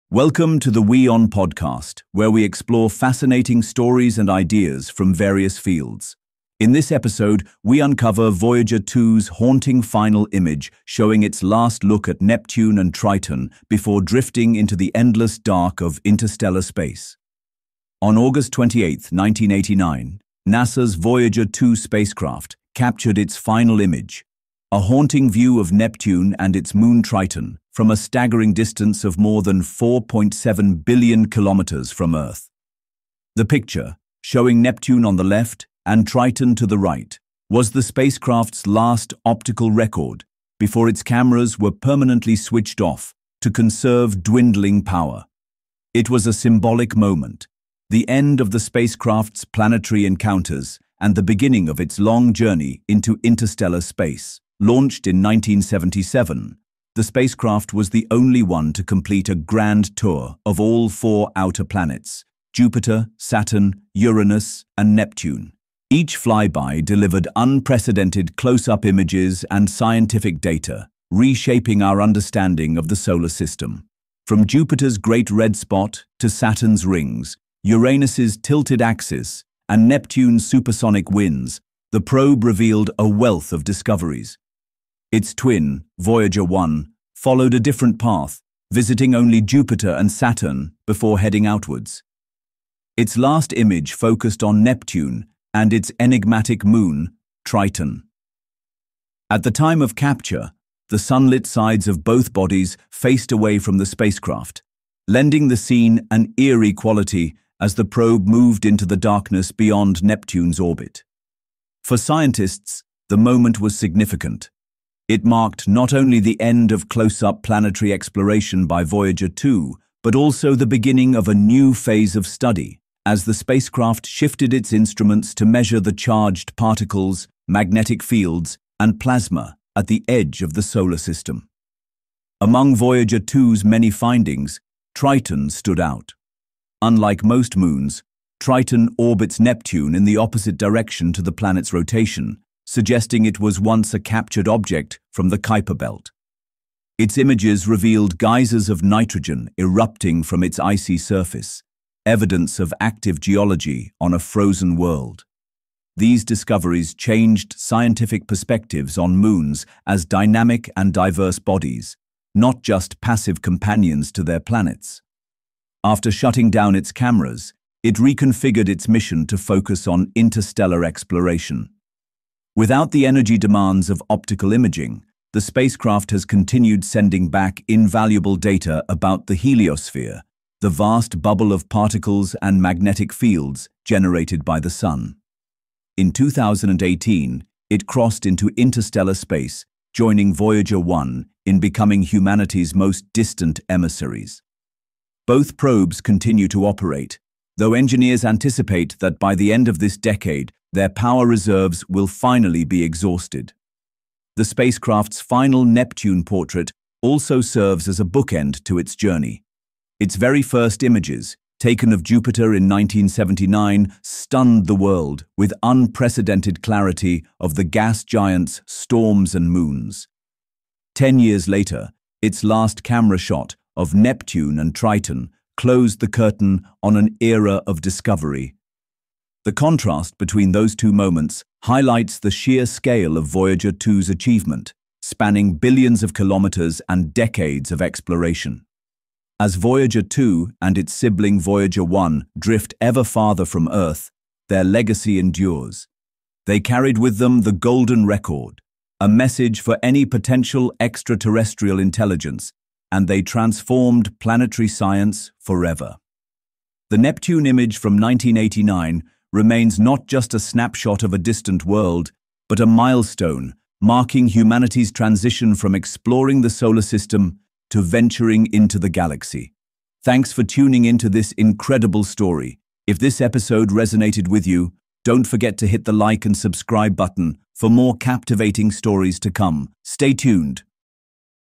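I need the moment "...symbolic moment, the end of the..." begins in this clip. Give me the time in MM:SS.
00:46.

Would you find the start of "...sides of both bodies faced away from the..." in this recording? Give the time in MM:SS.
01:41.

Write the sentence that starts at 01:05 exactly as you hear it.
Each flyby delivered unprecedented close-up images and scientific data, reshaping our understanding of the solar system.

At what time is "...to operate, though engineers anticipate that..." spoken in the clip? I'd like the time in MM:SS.
03:16.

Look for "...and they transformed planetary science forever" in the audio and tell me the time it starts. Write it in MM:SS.
04:12.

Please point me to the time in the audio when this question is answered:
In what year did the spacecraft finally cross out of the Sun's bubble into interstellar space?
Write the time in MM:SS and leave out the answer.
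03:06.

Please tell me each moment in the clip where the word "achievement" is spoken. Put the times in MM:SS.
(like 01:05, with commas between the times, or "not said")
03:54.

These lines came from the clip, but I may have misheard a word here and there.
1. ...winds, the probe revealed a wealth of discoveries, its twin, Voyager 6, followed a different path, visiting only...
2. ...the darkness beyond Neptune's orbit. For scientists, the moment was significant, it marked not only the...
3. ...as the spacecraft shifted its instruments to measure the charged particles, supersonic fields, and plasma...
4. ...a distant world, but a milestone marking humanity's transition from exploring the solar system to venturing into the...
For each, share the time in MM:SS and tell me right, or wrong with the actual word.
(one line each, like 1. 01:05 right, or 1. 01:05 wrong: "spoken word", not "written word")
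1. 01:21 wrong: "1", not "6"
2. 01:48 right
3. 02:03 wrong: "magnetic", not "supersonic"
4. 04:21 right.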